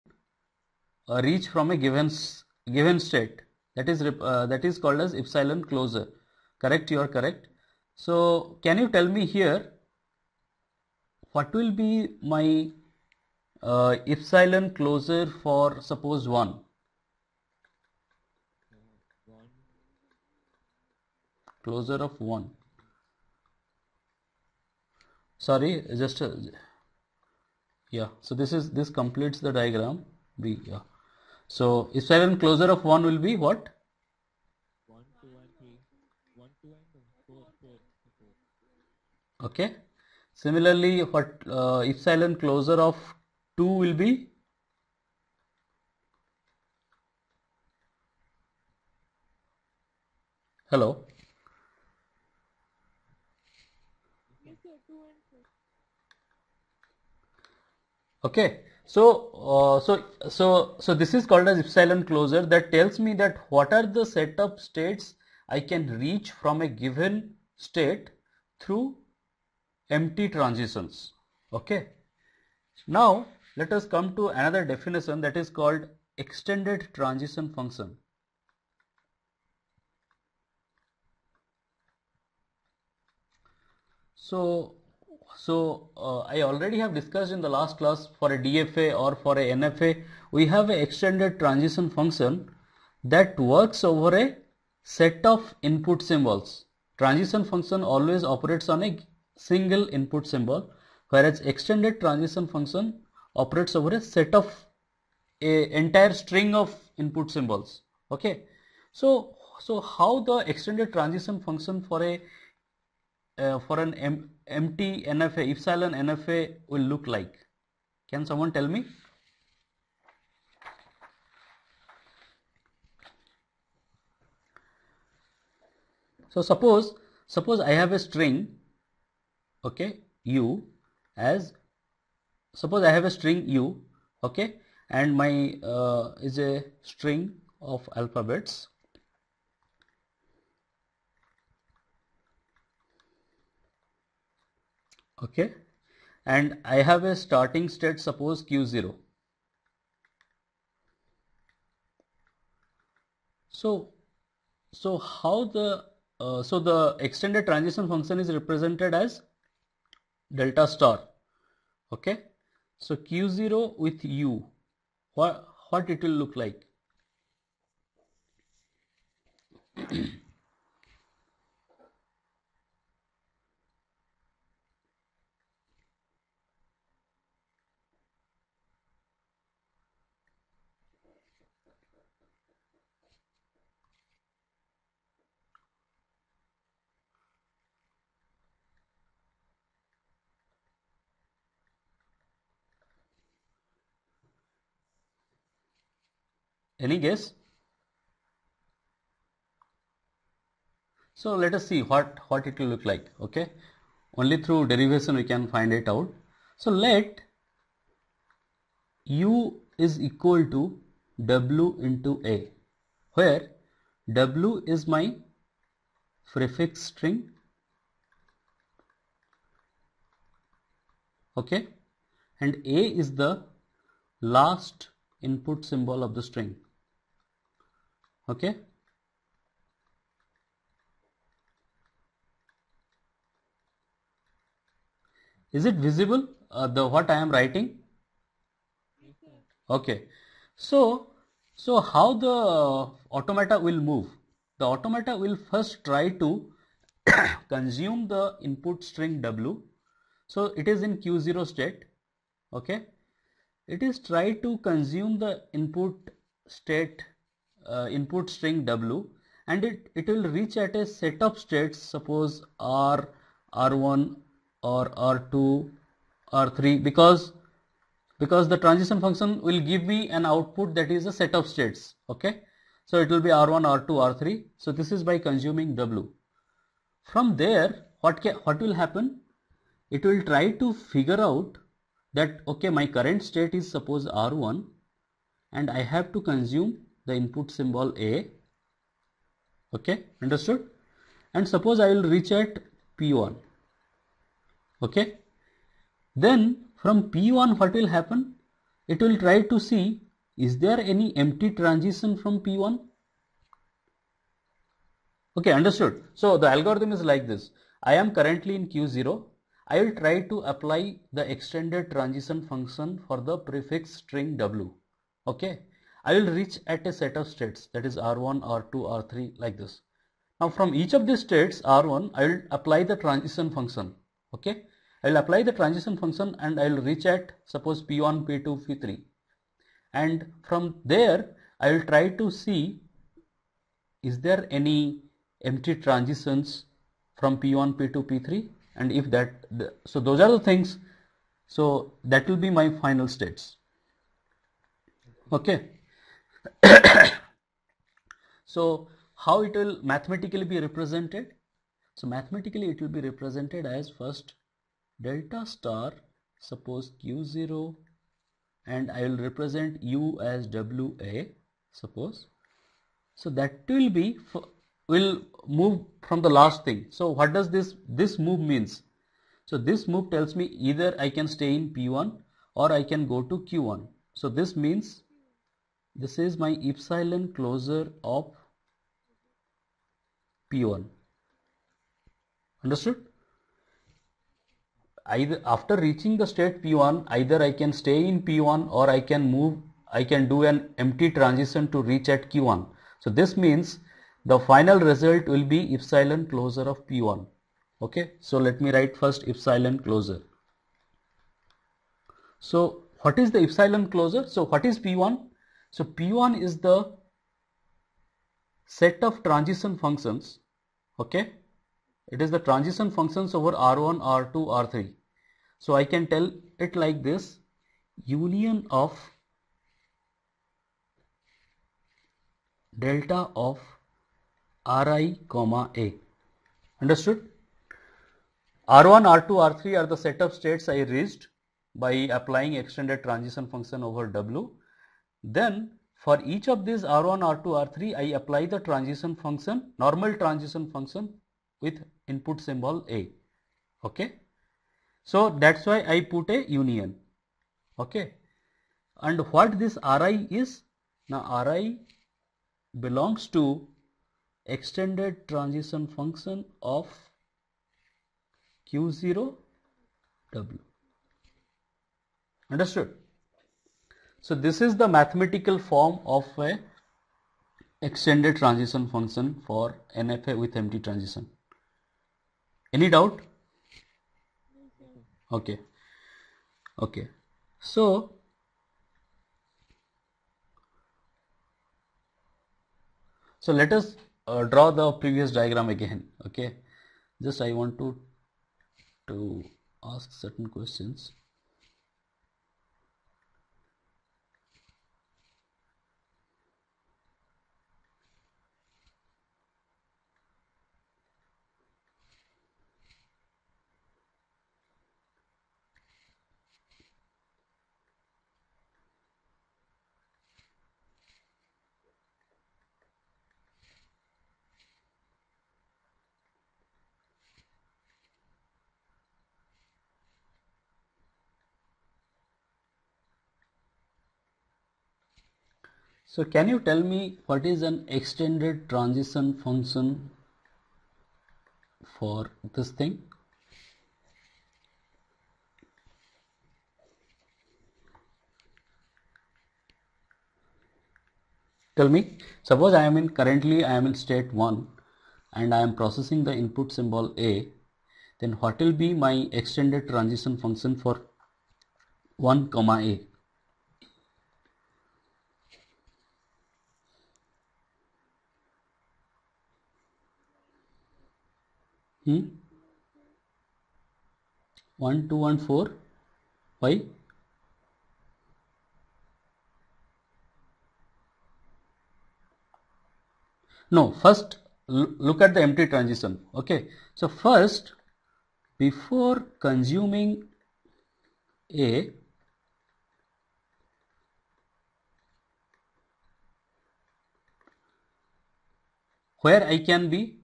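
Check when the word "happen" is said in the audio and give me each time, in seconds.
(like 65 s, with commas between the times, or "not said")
278 s, 297 s.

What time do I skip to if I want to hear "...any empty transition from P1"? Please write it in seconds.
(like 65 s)
300 s.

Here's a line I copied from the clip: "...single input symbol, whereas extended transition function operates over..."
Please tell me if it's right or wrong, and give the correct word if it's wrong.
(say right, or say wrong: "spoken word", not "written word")
right.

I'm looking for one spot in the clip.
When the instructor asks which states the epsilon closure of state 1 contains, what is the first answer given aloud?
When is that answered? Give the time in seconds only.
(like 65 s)
34 s.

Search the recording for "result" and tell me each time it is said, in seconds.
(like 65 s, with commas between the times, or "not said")
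394 s.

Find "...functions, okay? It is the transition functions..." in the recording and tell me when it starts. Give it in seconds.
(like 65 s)
409 s.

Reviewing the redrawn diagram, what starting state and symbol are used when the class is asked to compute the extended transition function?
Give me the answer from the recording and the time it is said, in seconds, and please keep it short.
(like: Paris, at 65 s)
state 1 and A, at 552 s.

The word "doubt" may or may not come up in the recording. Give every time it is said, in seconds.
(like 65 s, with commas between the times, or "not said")
472 s.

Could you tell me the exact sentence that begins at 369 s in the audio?
So this move tells me either I can stay in p1 or I can go to q1.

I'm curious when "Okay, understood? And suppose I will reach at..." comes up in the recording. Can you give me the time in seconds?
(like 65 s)
289 s.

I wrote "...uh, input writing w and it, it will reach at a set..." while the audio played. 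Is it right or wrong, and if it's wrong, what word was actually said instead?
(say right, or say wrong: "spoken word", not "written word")
wrong: "string", not "writing".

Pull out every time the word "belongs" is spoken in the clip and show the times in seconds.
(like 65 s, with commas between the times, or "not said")
452 s.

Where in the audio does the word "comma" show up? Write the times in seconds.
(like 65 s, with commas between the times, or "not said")
425 s, 552 s.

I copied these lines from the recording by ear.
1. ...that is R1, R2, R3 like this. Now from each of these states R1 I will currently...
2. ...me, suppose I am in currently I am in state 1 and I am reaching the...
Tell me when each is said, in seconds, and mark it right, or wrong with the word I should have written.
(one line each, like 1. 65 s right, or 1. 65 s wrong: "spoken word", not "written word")
1. 317 s wrong: "apply", not "currently"
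2. 541 s wrong: "processing", not "reaching".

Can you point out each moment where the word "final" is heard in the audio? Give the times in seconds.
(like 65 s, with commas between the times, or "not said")
342 s, 394 s.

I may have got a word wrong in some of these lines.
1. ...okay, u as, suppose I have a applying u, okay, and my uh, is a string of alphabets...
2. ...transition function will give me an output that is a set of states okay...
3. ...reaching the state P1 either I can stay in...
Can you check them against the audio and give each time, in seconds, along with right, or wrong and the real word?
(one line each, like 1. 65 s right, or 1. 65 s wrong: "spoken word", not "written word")
1. 129 s wrong: "string", not "applying"
2. 268 s right
3. 385 s right.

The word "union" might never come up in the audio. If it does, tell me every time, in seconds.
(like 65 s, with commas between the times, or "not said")
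418 s, 446 s.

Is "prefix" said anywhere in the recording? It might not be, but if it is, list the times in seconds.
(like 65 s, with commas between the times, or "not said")
216 s, 313 s.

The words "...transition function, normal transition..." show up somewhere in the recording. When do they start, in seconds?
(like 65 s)
438 s.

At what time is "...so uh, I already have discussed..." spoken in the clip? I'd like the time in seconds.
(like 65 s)
85 s.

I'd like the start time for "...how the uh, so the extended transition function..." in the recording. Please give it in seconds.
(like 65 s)
154 s.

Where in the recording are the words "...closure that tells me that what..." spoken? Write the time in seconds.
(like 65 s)
62 s.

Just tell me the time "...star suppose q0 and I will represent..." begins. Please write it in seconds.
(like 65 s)
355 s.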